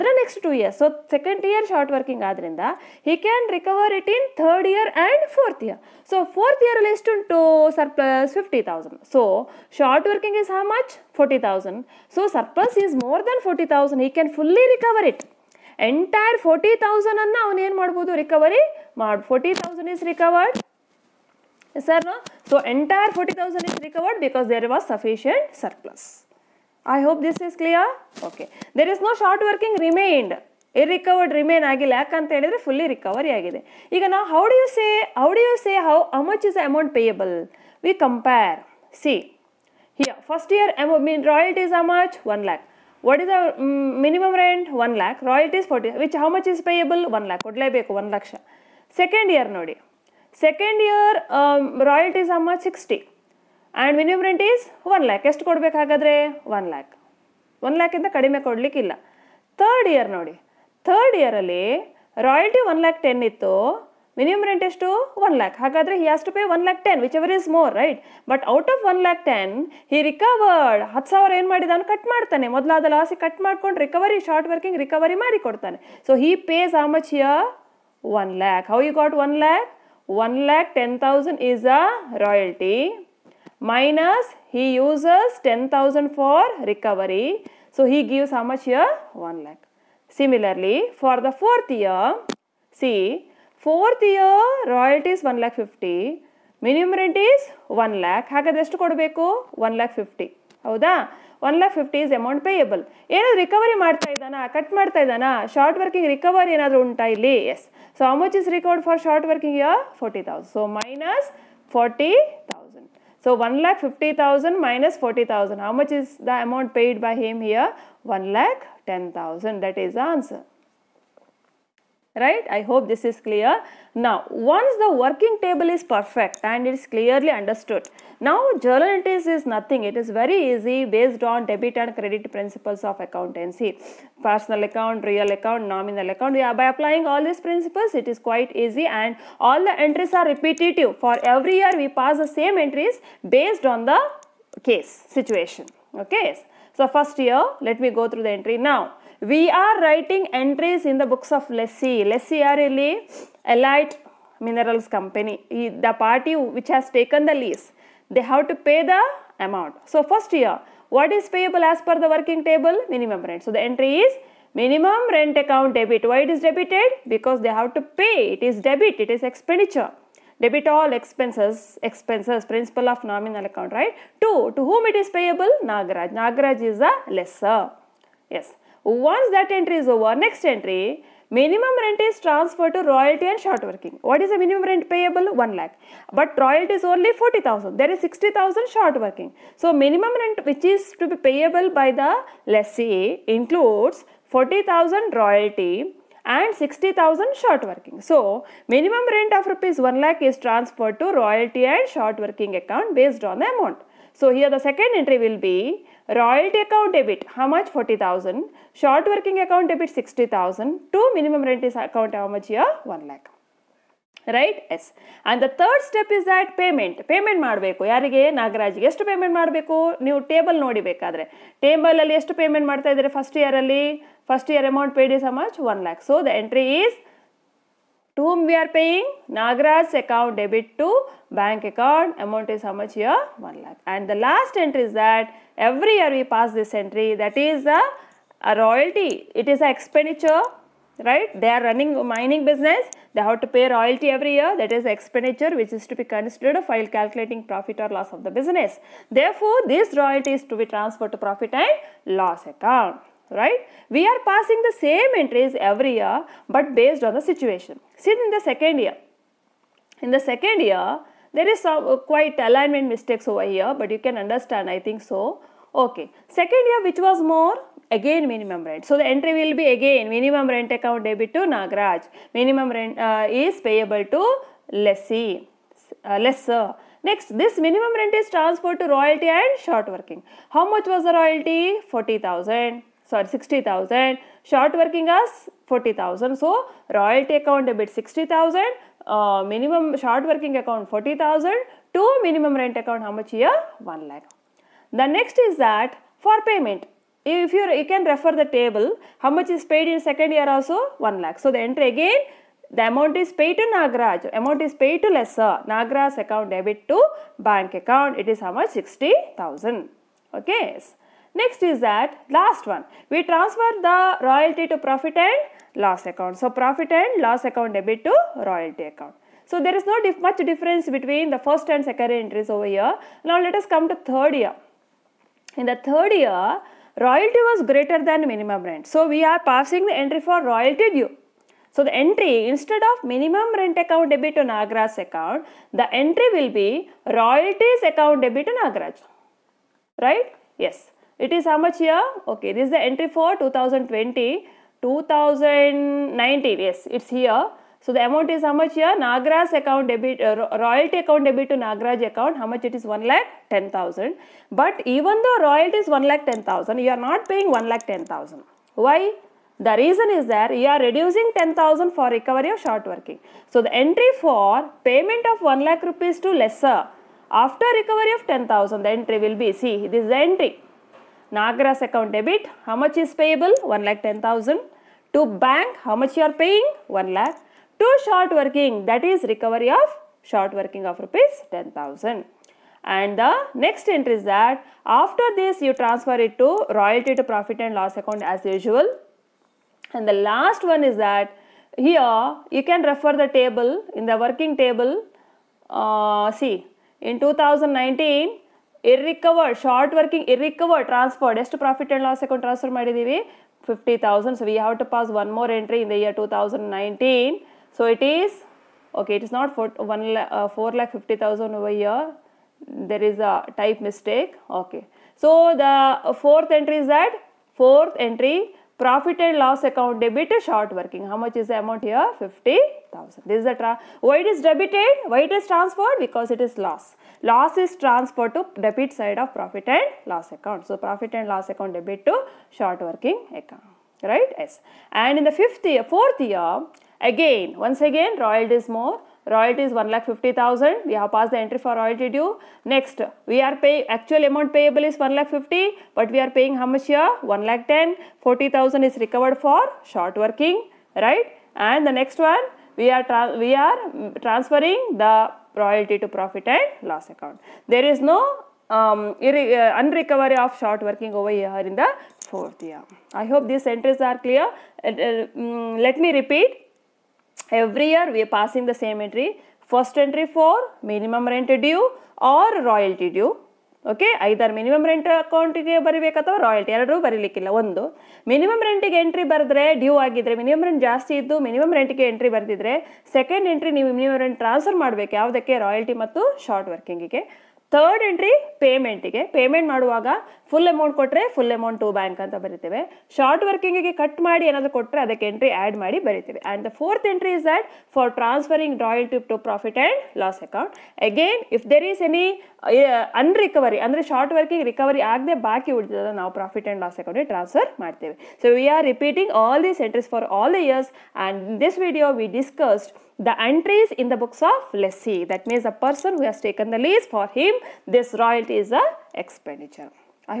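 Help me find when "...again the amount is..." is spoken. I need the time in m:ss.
5:01.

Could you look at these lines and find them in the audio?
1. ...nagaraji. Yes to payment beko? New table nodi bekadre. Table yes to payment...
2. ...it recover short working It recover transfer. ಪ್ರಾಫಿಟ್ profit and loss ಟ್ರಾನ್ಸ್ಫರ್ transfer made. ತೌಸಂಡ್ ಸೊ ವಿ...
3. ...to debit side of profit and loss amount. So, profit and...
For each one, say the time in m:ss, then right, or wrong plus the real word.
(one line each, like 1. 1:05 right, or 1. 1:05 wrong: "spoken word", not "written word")
1. 3:38 right
2. 6:38 right
3. 7:08 wrong: "account", not "amount".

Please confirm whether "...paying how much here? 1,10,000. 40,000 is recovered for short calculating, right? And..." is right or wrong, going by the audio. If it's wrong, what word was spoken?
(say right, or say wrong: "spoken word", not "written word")
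wrong: "working", not "calculating".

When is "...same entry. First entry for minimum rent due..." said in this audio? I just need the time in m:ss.
7:48.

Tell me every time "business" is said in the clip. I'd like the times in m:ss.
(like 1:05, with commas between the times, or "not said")
4:02, 4:08.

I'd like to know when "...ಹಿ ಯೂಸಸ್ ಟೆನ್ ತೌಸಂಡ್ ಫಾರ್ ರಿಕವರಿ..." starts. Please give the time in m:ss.
1:24.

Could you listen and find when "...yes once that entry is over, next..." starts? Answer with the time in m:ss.
2:58.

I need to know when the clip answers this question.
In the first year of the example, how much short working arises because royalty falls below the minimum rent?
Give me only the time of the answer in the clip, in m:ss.
3:07.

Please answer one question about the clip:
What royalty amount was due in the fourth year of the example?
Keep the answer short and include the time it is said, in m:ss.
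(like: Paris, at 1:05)
1,50,000, at 7:19.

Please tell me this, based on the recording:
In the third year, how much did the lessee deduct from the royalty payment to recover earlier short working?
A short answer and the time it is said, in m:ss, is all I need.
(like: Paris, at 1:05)
10,000, at 1:10.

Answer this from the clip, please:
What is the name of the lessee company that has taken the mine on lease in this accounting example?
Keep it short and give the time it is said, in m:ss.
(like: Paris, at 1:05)
Elite minerals company, at 2:33.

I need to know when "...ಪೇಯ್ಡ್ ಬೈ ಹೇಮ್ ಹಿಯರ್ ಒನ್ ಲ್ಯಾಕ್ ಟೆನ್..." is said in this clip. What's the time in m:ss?
1:56.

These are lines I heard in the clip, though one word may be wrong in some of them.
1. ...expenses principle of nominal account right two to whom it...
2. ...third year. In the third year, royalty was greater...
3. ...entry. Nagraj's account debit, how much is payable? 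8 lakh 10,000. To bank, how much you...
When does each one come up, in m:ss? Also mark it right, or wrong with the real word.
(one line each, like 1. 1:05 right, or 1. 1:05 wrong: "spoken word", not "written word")
1. 2:51 right
2. 5:23 right
3. 6:10 wrong: "1", not "8".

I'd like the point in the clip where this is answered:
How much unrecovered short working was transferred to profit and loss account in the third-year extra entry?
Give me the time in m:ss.
7:02.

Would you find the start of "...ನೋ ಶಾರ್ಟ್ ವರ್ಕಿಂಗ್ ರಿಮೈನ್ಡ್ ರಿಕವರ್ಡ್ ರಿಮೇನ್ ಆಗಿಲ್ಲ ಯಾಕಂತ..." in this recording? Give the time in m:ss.
0:29.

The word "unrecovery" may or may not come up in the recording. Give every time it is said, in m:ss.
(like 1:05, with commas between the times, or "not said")
7:39.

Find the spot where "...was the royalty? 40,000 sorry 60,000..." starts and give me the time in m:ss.
4:40.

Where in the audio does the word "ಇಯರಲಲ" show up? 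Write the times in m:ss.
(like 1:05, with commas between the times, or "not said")
0:06, 1:01.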